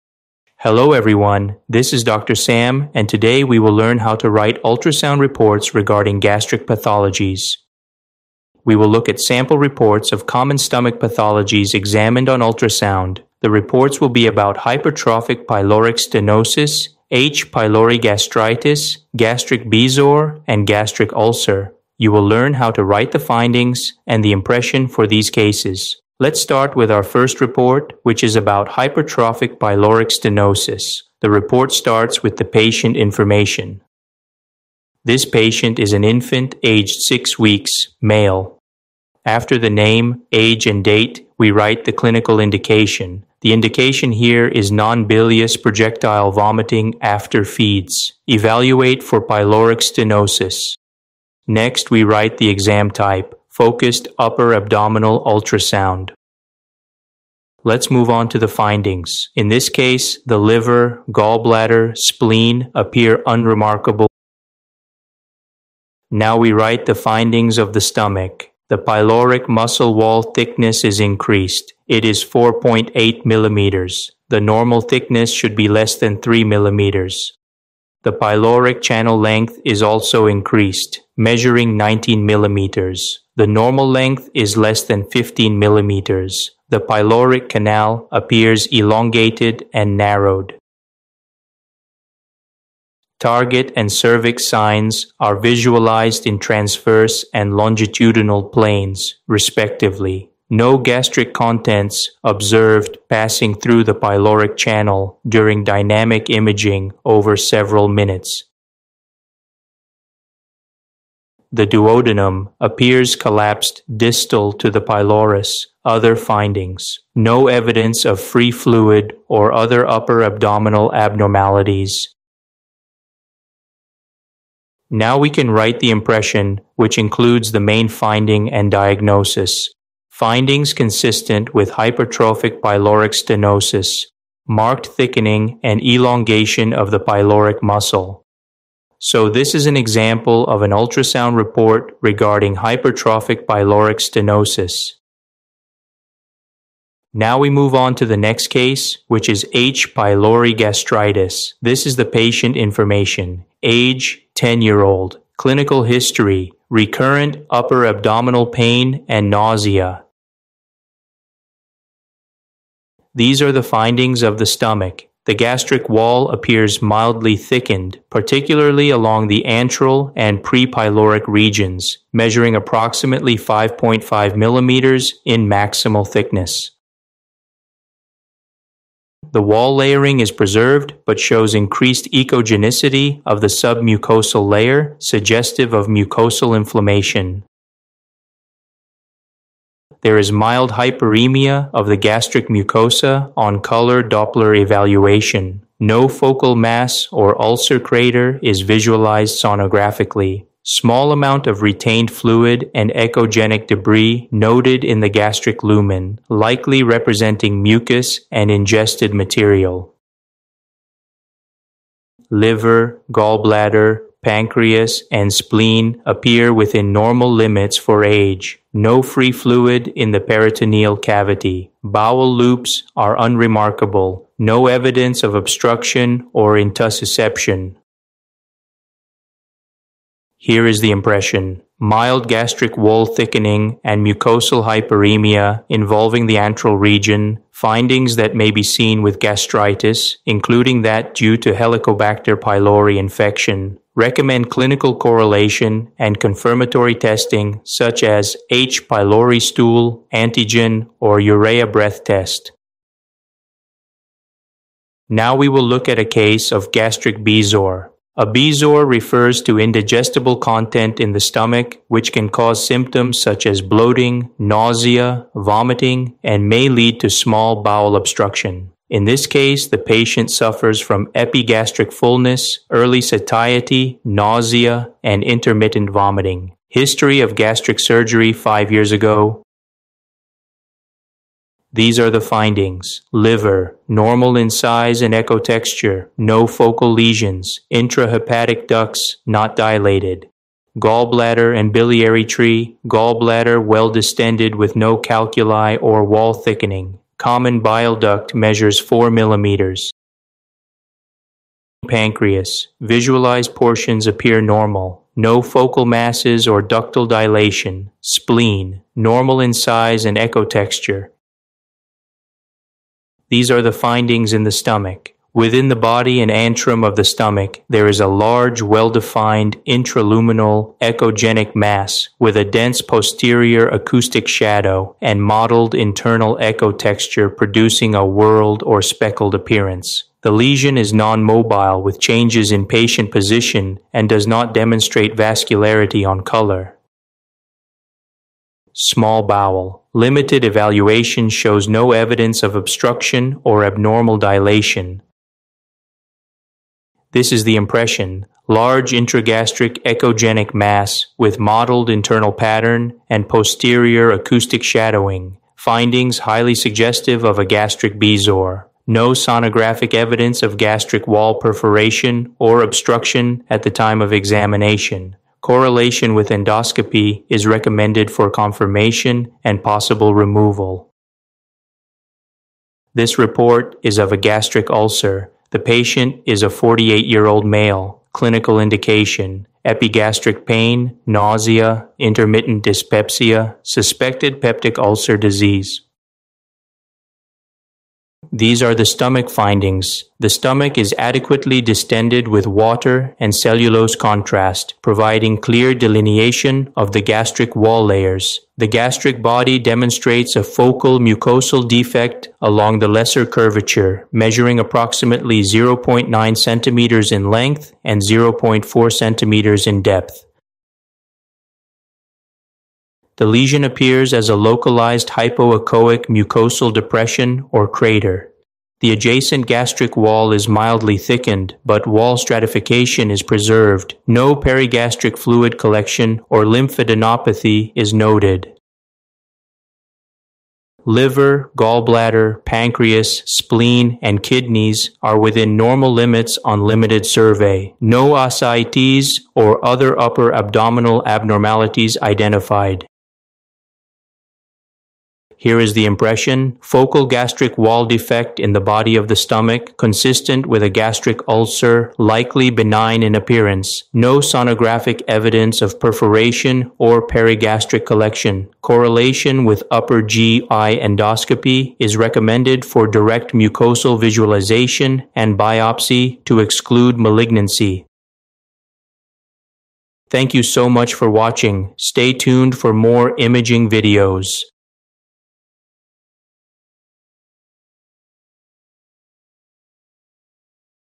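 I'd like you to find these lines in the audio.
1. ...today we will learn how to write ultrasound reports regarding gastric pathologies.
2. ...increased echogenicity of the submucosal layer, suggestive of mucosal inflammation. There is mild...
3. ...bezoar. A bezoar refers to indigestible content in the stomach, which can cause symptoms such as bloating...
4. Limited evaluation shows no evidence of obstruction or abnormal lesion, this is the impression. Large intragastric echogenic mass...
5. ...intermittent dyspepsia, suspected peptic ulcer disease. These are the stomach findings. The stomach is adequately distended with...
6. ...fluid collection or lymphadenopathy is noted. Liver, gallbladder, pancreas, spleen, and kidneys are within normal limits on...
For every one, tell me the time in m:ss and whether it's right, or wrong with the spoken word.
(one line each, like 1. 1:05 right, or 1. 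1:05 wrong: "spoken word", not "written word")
1. 0:03 right
2. 3:01 right
3. 4:17 right
4. 5:39 wrong: "dilation", not "lesion"
5. 6:21 right
6. 7:05 right.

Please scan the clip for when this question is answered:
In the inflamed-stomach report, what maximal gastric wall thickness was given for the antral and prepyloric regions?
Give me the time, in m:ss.
2:53.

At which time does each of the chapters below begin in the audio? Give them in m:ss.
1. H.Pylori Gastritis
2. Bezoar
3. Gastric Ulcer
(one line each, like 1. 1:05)
1. 2:27
2. 4:15
3. 6:13.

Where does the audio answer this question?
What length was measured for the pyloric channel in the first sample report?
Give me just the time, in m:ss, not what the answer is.
1:21.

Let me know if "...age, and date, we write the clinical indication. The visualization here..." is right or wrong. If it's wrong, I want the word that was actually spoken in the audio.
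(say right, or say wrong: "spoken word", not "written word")
wrong: "indication", not "visualization".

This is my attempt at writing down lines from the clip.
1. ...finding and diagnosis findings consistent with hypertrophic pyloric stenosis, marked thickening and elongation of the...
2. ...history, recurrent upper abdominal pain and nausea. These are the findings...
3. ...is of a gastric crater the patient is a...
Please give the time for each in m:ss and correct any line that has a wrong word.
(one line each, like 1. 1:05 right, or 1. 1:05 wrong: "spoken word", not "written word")
1. 2:07 right
2. 2:35 right
3. 6:13 wrong: "ulcer", not "crater".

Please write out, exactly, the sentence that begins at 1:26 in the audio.
The pyloric canal appears elongated and narrowed.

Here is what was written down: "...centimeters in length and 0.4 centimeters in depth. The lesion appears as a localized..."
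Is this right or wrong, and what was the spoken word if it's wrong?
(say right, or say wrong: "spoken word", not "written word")
right.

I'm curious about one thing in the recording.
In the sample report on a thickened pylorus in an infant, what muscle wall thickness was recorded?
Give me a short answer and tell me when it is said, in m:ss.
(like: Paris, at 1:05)
4.8 mm, at 1:12.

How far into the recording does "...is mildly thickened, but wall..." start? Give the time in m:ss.
7:00.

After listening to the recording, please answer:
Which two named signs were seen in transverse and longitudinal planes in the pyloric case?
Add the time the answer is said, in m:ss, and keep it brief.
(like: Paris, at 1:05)
Target and cervix signs, at 1:33.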